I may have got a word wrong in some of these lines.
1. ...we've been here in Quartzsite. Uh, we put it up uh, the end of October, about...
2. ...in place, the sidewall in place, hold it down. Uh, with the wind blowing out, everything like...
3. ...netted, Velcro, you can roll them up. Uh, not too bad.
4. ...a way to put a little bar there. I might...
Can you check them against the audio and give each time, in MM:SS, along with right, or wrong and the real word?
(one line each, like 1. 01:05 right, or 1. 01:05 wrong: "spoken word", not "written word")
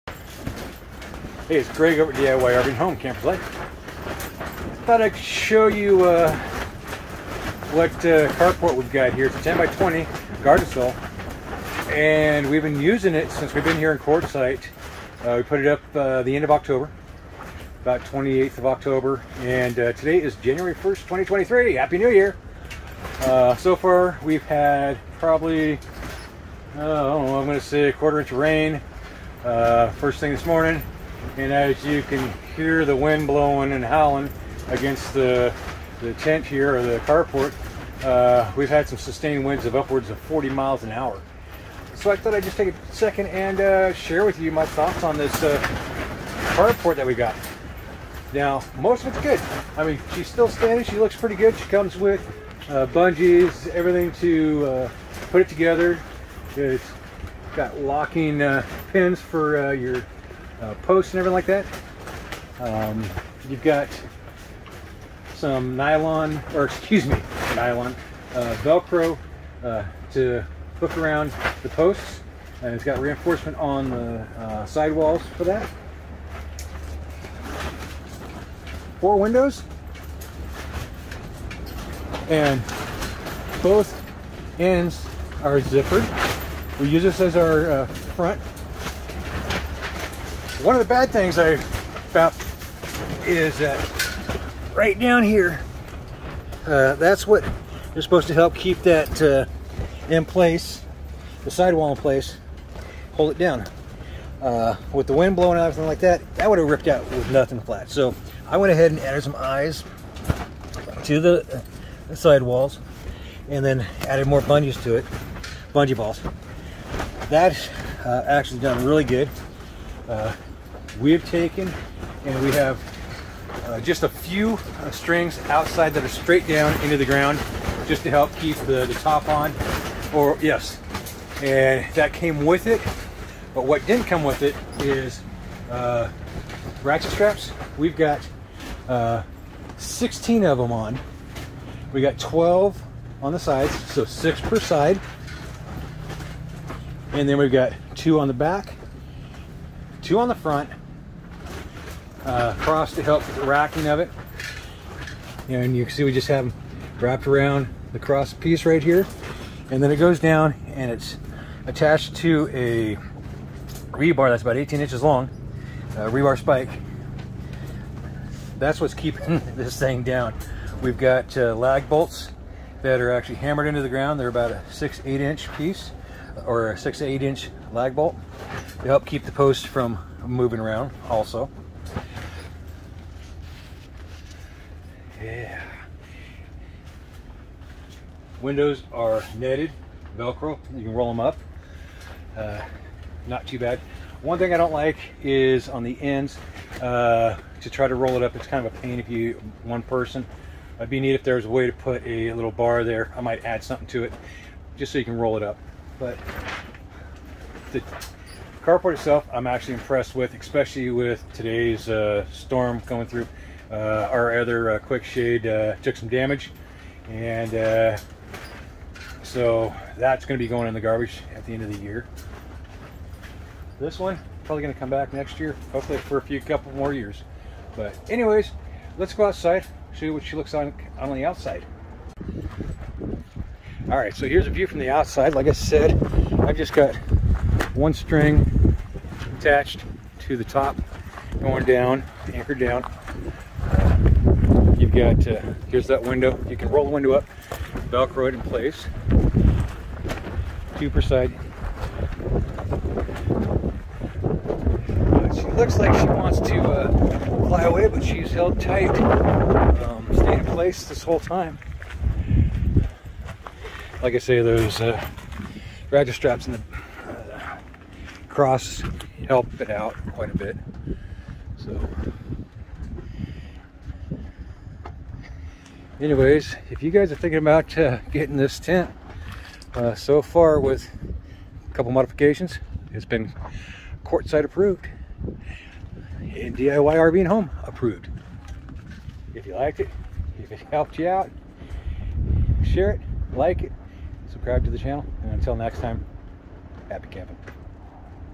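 1. 00:13 right
2. 01:40 right
3. 03:09 right
4. 03:21 right.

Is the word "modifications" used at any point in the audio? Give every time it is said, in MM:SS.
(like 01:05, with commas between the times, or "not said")
04:41.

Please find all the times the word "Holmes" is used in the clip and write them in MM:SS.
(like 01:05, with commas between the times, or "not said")
not said.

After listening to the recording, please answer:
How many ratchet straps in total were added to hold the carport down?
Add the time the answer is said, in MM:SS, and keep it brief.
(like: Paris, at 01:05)
16, at 02:19.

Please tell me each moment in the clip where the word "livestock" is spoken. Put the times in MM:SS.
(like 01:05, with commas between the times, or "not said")
not said.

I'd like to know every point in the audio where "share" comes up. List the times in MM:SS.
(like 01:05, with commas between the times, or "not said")
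00:43, 04:52.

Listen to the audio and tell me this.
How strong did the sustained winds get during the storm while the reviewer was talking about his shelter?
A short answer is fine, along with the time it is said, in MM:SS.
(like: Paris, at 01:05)
40 miles an hour, at 00:40.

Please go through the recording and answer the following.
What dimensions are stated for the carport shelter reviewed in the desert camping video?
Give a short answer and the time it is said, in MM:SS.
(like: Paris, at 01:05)
10 by 20, at 00:09.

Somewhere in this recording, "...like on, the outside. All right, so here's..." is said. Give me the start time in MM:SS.
03:50.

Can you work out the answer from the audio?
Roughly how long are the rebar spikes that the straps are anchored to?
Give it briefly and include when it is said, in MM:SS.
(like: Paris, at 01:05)
18 inches, at 02:44.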